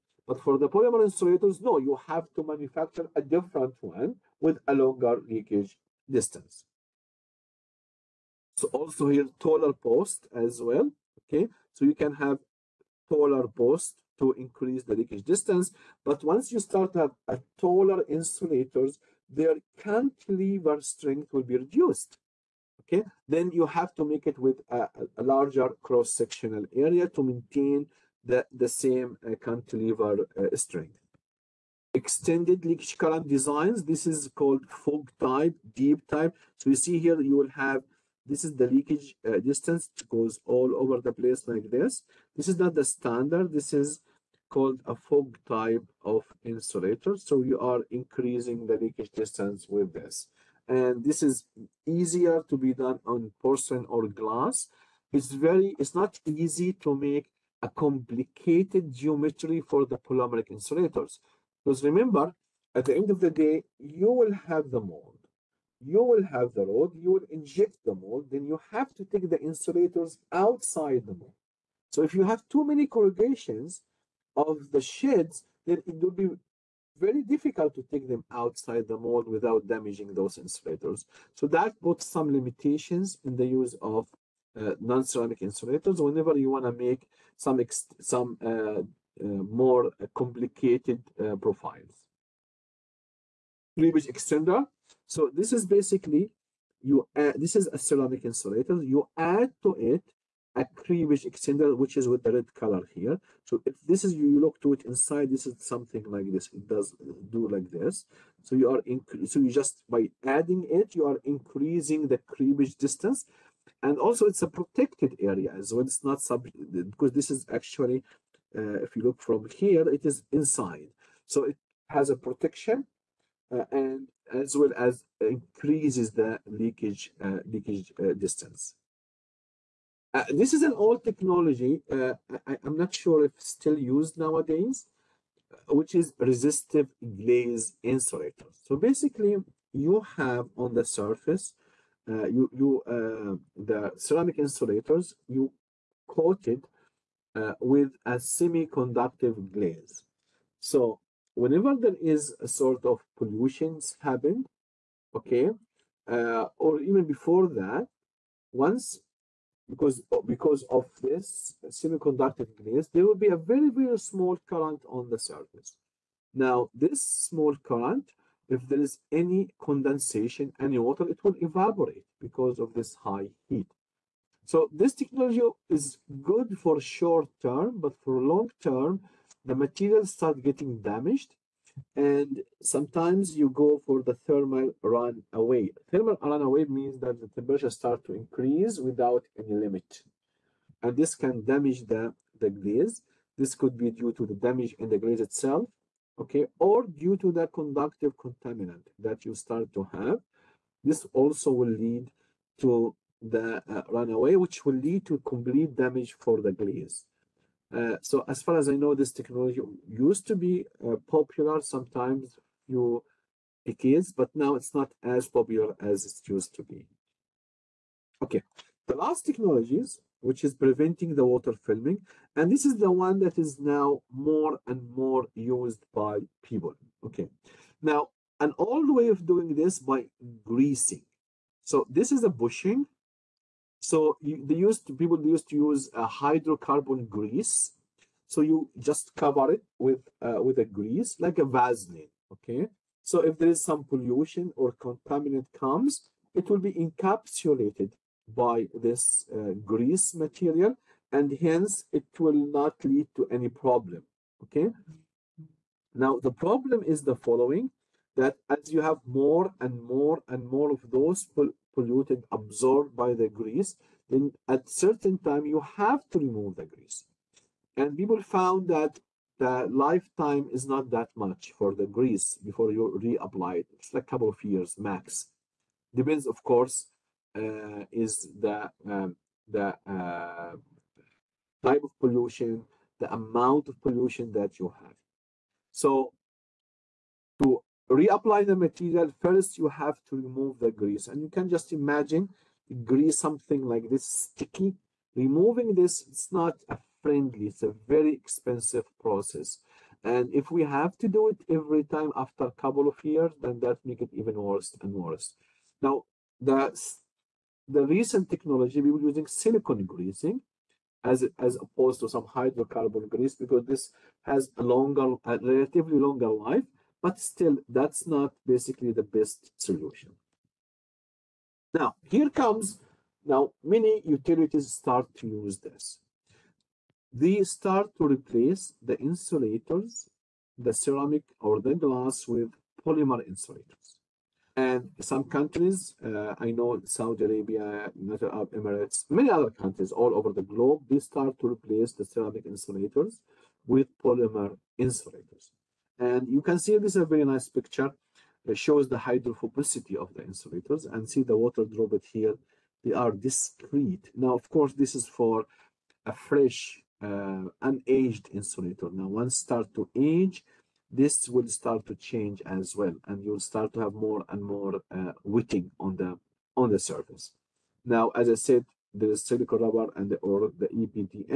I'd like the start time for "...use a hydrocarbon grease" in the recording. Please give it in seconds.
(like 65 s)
235 s.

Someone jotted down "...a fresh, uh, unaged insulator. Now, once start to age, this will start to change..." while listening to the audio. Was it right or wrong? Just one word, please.
right.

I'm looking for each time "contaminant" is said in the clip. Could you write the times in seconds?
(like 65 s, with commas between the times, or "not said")
198 s, 244 s.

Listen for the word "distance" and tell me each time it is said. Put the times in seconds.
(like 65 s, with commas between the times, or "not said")
6 s, 15 s, 39 s, 49 s, 112 s, 128 s.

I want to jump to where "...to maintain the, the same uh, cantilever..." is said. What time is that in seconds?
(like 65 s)
27 s.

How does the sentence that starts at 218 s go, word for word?
Okay, the last technologies which is preventing the water filming.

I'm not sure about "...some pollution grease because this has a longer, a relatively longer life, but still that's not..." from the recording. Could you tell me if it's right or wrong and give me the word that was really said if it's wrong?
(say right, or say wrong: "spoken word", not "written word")
wrong: "hydrocarbon", not "pollution".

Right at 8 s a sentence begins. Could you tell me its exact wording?
So also here, taller post as well, okay?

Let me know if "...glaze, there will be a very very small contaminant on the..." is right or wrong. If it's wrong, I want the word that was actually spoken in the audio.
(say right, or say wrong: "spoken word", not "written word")
wrong: "current", not "contaminant".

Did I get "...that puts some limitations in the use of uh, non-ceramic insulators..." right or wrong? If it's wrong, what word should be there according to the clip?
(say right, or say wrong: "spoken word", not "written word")
right.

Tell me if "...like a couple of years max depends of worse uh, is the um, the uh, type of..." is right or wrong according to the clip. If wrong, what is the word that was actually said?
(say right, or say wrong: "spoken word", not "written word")
wrong: "course", not "worse".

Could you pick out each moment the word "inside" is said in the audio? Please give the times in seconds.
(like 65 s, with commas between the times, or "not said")
104 s, 120 s.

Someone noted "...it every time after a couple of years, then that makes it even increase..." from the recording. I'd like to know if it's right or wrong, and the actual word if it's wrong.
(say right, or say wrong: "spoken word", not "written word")
wrong: "worse", not "increase".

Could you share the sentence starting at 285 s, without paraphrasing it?
So to reapply the material, first you have to remove the grease.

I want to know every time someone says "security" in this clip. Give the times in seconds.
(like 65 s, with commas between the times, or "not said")
not said.